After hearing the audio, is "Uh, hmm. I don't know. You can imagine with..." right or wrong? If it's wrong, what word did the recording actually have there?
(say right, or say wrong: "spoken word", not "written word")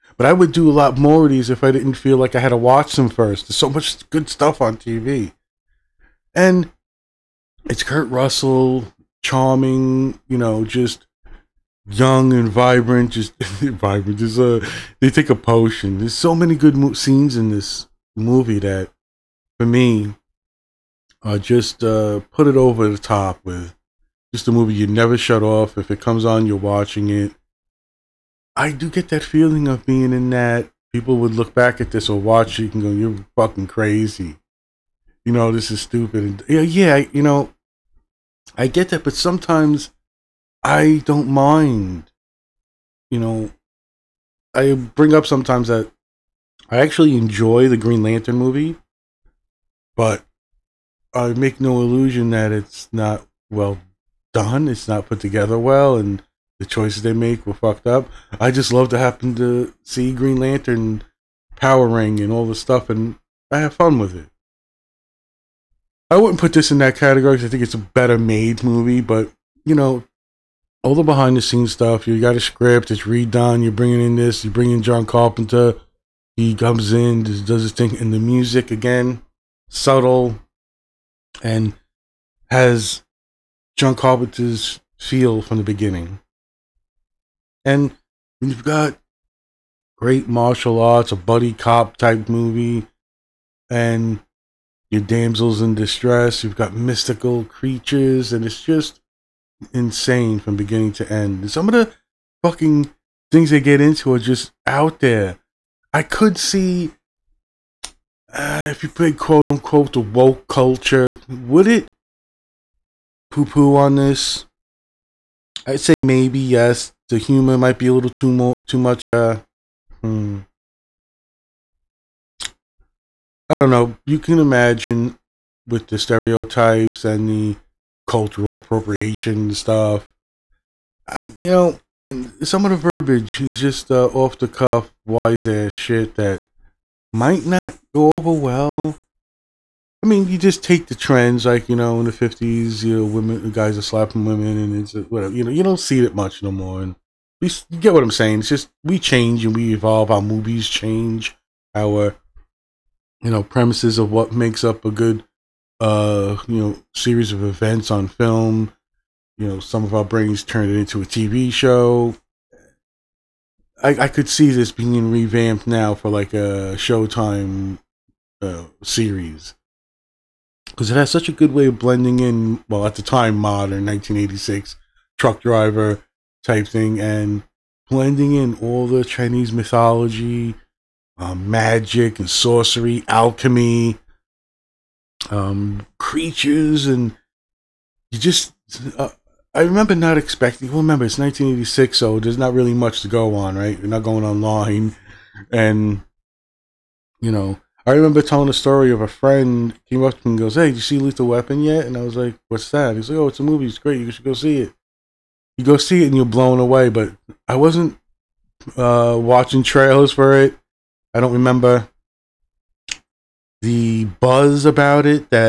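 right.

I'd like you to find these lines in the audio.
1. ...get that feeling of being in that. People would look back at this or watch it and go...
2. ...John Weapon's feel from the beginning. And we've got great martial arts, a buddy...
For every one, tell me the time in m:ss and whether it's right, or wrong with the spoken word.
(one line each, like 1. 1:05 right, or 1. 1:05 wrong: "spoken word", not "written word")
1. 0:28 right
2. 1:23 wrong: "Carpenter", not "Weapon".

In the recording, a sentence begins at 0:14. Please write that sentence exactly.
Just, uh, they take a potion.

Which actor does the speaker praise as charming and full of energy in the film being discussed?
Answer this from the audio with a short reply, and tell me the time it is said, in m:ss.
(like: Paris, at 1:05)
Kurt Russell, at 0:07.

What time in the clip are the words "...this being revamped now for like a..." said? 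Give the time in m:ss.
2:44.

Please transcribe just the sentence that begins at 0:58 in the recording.
I just love to happen to see Green Lantern, Power Ring, and all the stuff, and I have fun with it.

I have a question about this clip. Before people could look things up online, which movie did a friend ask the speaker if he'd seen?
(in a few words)
Lethal Weapon.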